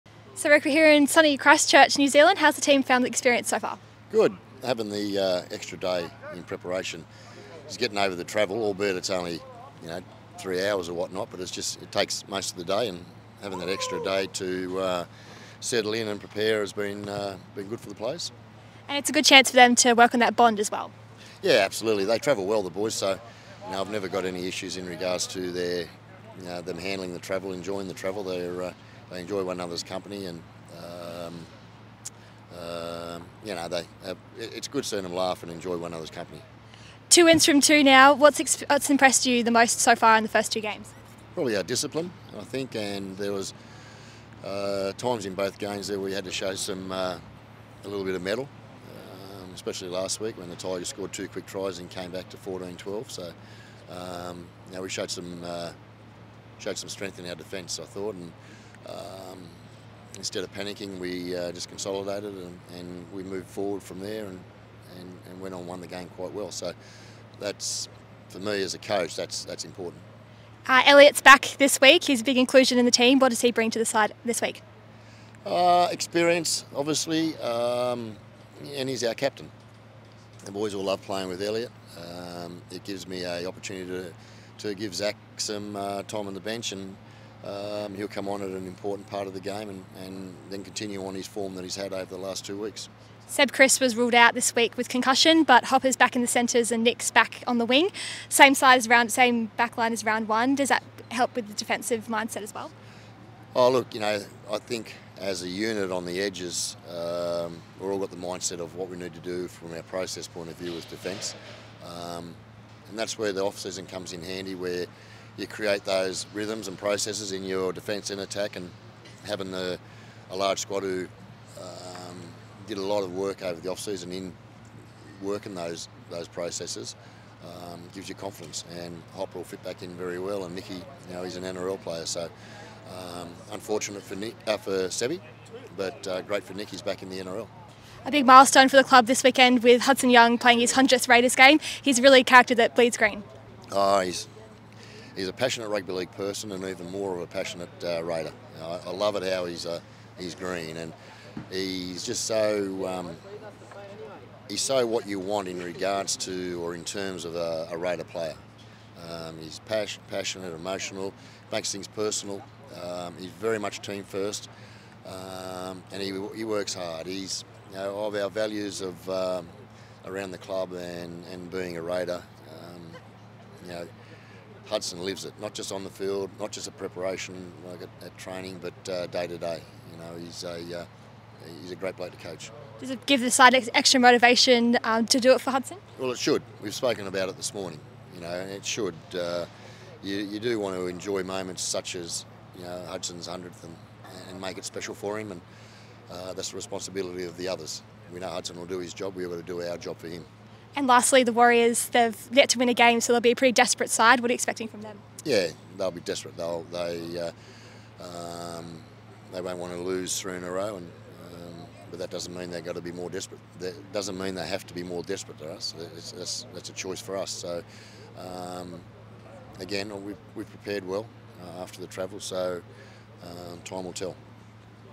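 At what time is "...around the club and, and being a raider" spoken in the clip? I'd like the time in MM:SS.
02:50.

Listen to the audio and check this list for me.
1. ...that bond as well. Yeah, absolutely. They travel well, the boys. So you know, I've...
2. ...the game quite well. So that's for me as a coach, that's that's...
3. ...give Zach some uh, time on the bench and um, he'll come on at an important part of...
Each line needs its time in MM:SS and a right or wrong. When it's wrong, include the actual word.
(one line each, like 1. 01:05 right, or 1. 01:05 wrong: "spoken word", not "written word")
1. 00:20 right
2. 01:05 right
3. 01:24 right.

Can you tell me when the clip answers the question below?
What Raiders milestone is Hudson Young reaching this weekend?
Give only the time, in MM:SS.
02:20.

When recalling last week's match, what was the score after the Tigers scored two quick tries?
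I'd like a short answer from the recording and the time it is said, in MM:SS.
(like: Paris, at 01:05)
14-12, at 00:52.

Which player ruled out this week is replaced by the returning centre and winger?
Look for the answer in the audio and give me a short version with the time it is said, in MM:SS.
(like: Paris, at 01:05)
Seb Kris, at 01:33.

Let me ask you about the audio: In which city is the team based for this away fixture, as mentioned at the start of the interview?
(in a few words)
Christchurch.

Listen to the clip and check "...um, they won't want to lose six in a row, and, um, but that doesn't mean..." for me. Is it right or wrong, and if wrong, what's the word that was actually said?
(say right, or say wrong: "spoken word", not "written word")
wrong: "three", not "six".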